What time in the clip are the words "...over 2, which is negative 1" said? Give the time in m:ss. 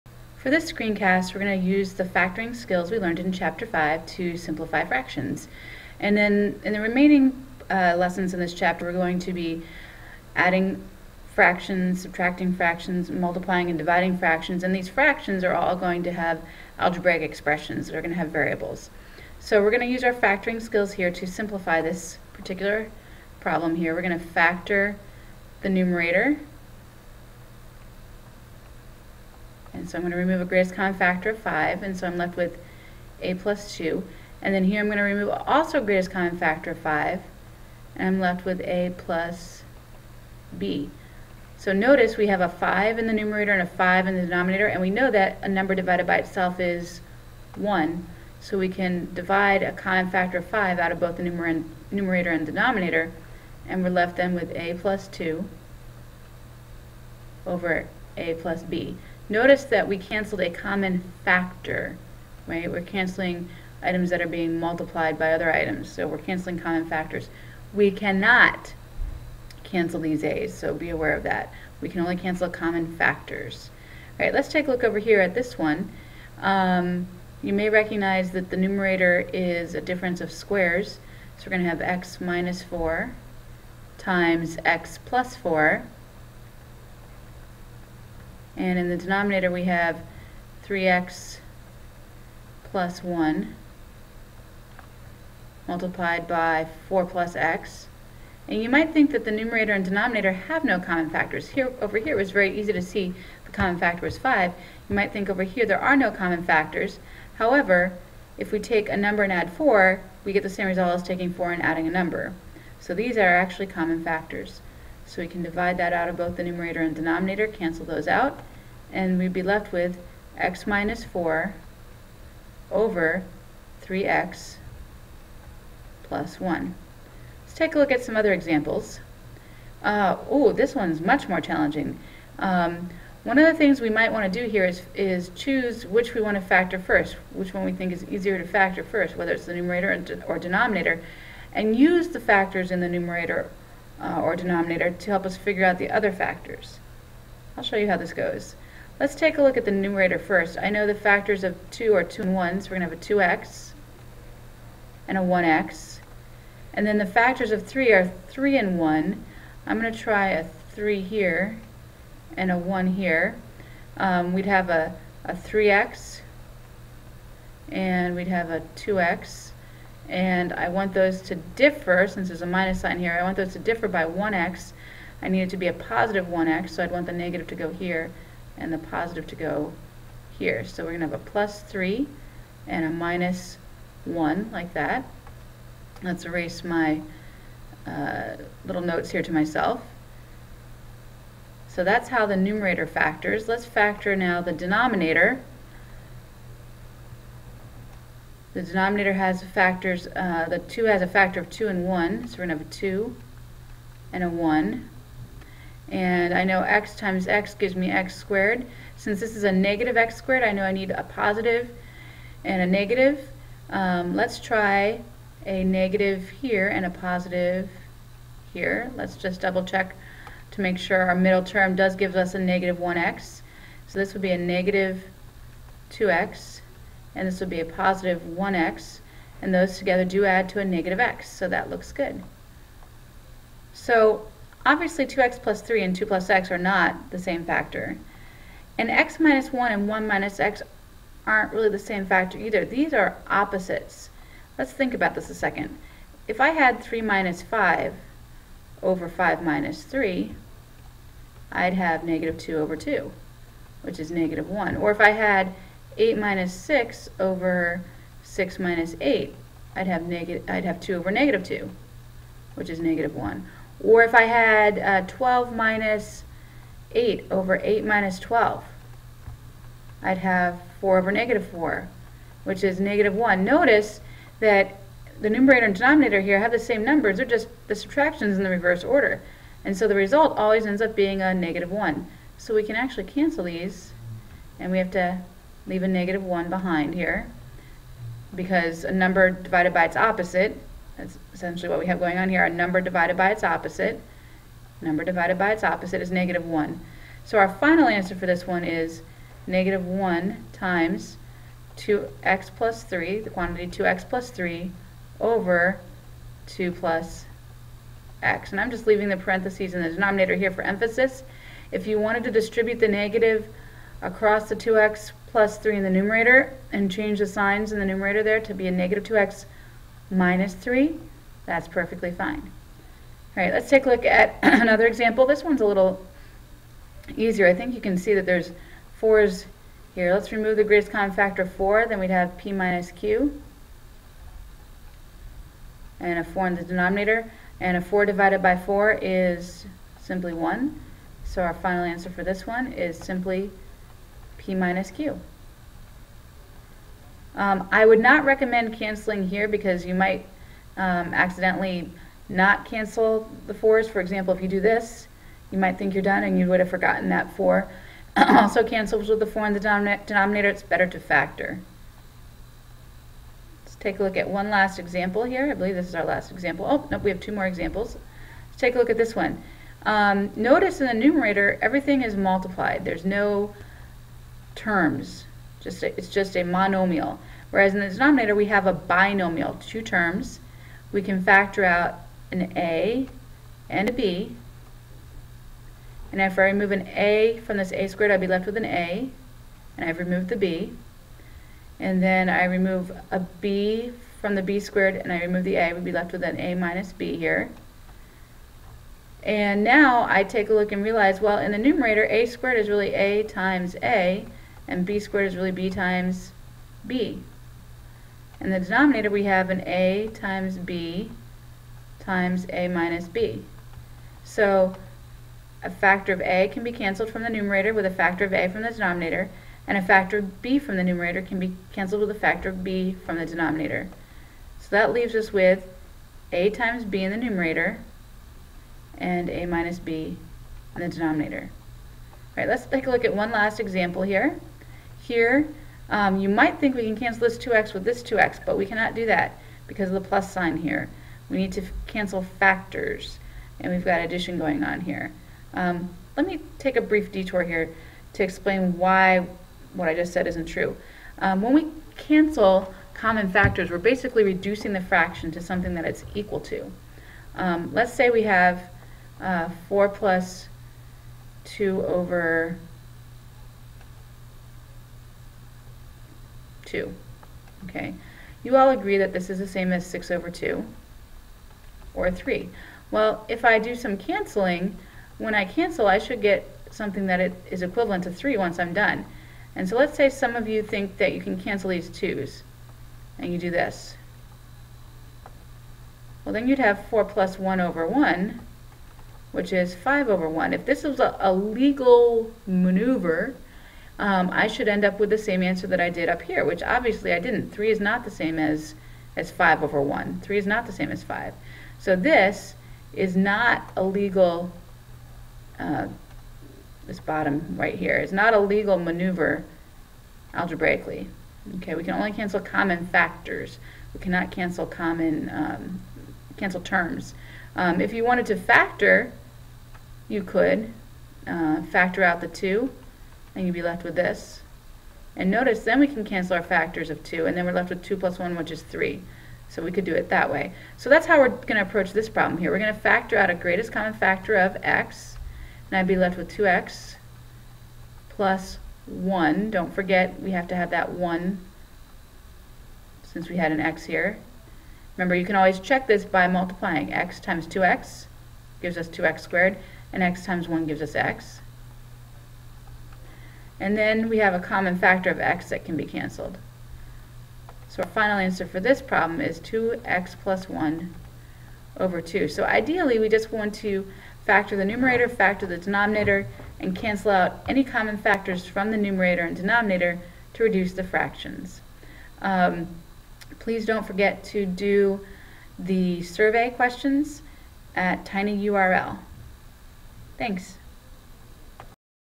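4:12.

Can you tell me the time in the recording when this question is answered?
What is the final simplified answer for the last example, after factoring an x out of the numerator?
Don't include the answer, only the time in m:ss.
9:19.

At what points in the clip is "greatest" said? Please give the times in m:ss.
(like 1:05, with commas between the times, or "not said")
0:30, 0:35, 5:30, 8:53.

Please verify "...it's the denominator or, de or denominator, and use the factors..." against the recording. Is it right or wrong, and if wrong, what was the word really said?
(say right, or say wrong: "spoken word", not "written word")
wrong: "numerator", not "denominator".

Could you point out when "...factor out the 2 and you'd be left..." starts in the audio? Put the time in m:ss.
8:41.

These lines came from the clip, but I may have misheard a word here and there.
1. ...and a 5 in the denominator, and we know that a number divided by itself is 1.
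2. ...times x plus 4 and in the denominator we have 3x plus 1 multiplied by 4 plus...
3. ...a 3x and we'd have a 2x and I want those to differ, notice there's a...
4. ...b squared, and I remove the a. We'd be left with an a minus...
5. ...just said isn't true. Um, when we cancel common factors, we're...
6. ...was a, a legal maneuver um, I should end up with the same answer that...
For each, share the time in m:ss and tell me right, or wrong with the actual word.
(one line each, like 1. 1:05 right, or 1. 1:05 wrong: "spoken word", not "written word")
1. 0:43 right
2. 1:23 right
3. 2:45 wrong: "since", not "notice"
4. 6:34 right
5. 7:29 right
6. 8:10 right.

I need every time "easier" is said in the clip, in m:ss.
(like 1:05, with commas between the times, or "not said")
2:18, 5:27.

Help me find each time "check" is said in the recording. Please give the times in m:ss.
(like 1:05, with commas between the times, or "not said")
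3:39, 9:05.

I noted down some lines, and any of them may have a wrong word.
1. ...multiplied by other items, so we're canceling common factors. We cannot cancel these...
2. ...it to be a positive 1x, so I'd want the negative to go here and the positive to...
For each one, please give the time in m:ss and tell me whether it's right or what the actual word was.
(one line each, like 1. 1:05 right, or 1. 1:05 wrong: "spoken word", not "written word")
1. 1:04 right
2. 2:55 right.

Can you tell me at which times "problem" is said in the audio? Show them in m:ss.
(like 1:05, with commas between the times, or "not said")
0:23, 8:52, 9:18.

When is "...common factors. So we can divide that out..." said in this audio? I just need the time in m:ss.
1:53.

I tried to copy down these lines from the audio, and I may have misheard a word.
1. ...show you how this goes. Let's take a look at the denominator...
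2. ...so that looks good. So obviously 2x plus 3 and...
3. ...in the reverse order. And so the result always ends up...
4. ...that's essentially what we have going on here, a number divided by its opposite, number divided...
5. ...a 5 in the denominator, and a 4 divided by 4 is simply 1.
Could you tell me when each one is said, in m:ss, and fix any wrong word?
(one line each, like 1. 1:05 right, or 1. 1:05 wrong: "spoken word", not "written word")
1. 2:27 wrong: "numerator", not "denominator"
2. 3:51 right
3. 4:38 right
4. 4:50 right
5. 5:36 wrong: "4", not "5".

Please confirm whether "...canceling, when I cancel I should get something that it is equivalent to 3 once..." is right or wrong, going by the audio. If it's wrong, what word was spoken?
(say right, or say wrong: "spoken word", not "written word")
right.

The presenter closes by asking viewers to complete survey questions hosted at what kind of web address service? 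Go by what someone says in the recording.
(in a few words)
tinyurl.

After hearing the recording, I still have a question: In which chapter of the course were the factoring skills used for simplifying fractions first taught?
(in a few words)
Chapter 5.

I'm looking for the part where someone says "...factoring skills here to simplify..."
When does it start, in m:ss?
0:20.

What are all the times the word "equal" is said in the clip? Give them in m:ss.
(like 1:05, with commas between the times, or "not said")
7:36.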